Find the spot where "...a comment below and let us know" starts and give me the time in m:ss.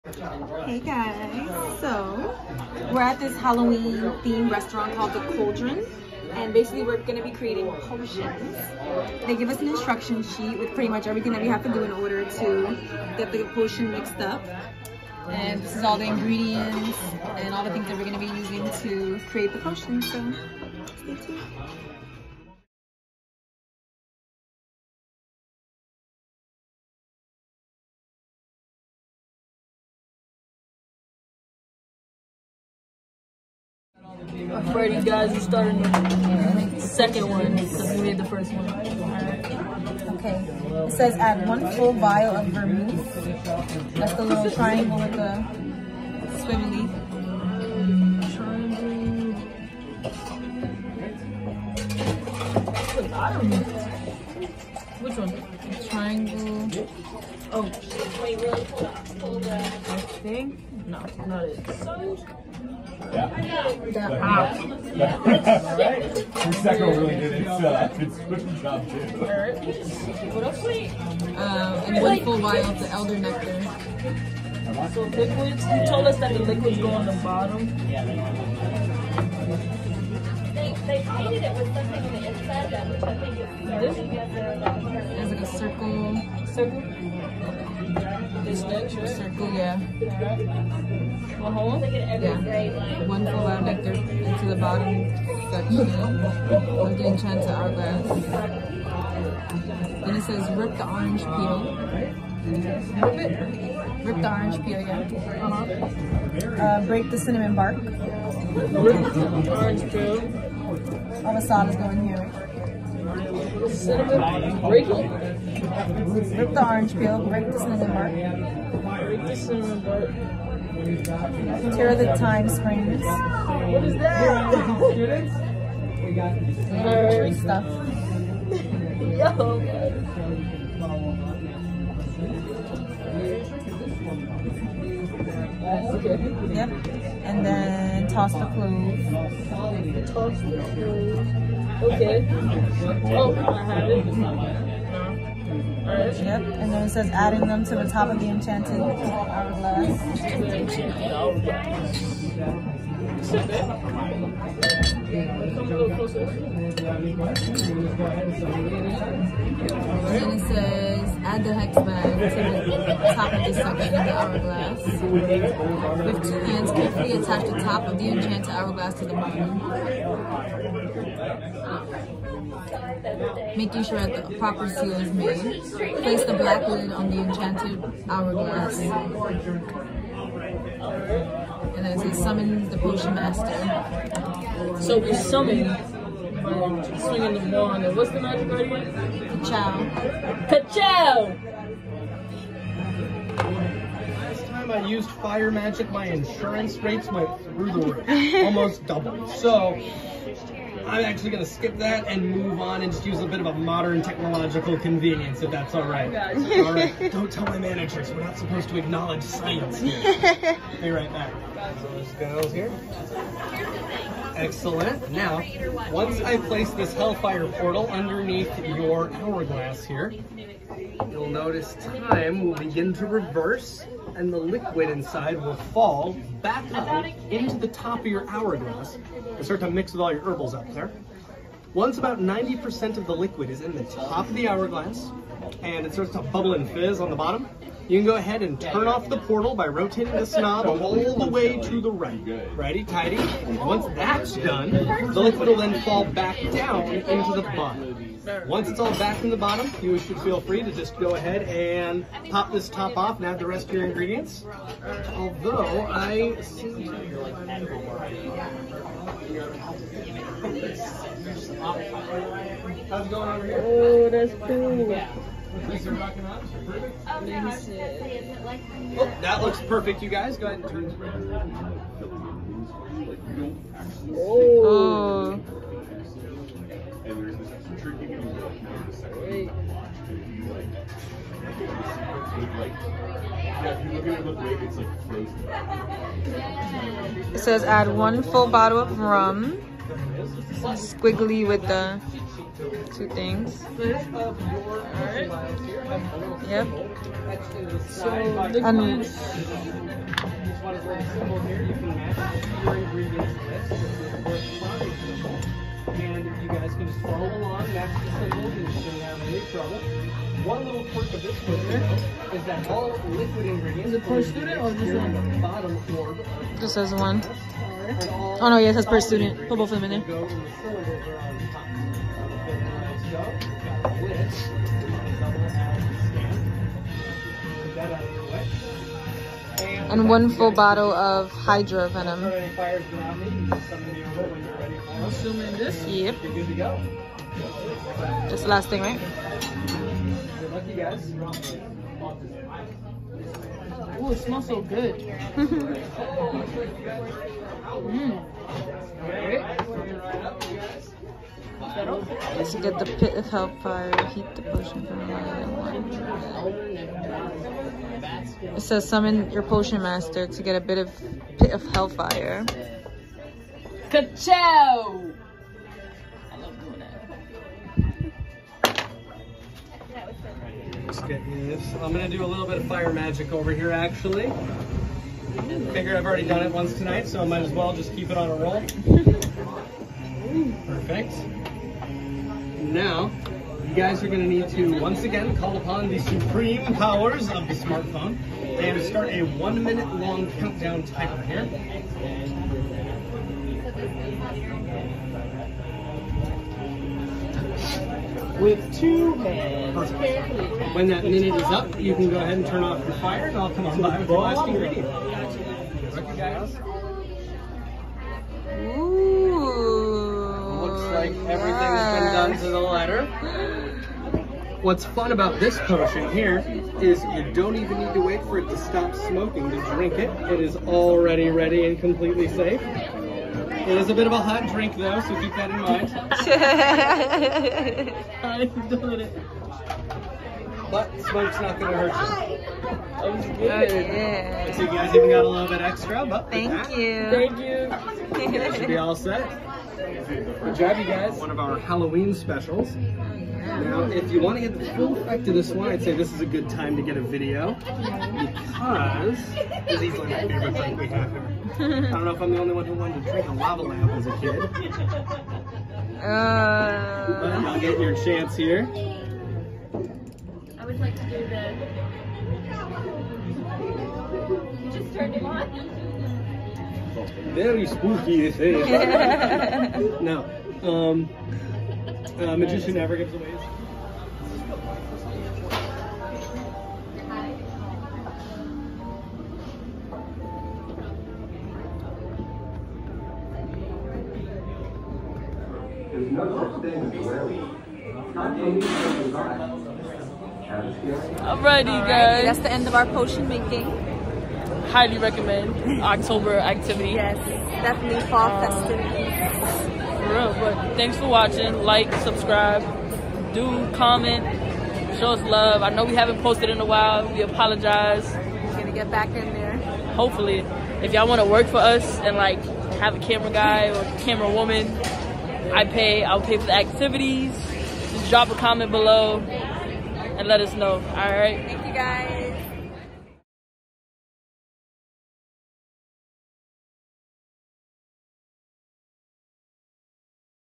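8:38.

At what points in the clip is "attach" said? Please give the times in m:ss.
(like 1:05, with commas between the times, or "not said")
2:47.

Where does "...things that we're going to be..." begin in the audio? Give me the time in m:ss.
0:17.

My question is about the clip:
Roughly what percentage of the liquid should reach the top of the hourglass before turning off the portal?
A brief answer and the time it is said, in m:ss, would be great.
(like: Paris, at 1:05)
90%, at 3:52.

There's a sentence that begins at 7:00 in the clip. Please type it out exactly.
It is already ready and completely safe.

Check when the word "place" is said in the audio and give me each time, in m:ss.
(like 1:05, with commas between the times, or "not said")
2:56, 3:36.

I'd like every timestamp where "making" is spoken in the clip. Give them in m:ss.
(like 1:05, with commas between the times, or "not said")
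2:53, 8:13.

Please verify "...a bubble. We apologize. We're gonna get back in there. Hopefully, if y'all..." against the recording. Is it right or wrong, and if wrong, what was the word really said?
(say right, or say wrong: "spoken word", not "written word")
wrong: "while", not "bubble".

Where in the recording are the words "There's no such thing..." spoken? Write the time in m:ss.
8:05.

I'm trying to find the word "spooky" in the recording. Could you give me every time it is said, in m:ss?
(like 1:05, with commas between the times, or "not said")
7:47.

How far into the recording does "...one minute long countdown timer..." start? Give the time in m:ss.
6:29.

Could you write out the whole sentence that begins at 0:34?
Alrighty guys, you are starting the second one because we made the first one.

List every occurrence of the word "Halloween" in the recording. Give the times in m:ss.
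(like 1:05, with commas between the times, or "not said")
0:03, 7:21.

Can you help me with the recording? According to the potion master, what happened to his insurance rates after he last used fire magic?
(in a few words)
Almost doubled.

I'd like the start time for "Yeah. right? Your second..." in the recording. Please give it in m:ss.
1:04.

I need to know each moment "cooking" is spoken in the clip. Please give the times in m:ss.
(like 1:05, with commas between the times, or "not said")
1:08.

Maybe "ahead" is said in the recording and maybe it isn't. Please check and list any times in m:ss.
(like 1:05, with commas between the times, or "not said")
3:58, 4:11, 4:30, 6:42.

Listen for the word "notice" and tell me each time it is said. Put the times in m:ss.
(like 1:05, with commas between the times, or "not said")
3:41.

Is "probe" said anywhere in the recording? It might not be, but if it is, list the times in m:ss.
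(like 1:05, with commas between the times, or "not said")
not said.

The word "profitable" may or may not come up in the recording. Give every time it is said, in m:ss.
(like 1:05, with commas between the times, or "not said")
not said.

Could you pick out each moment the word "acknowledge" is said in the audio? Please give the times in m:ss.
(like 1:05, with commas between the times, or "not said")
3:28.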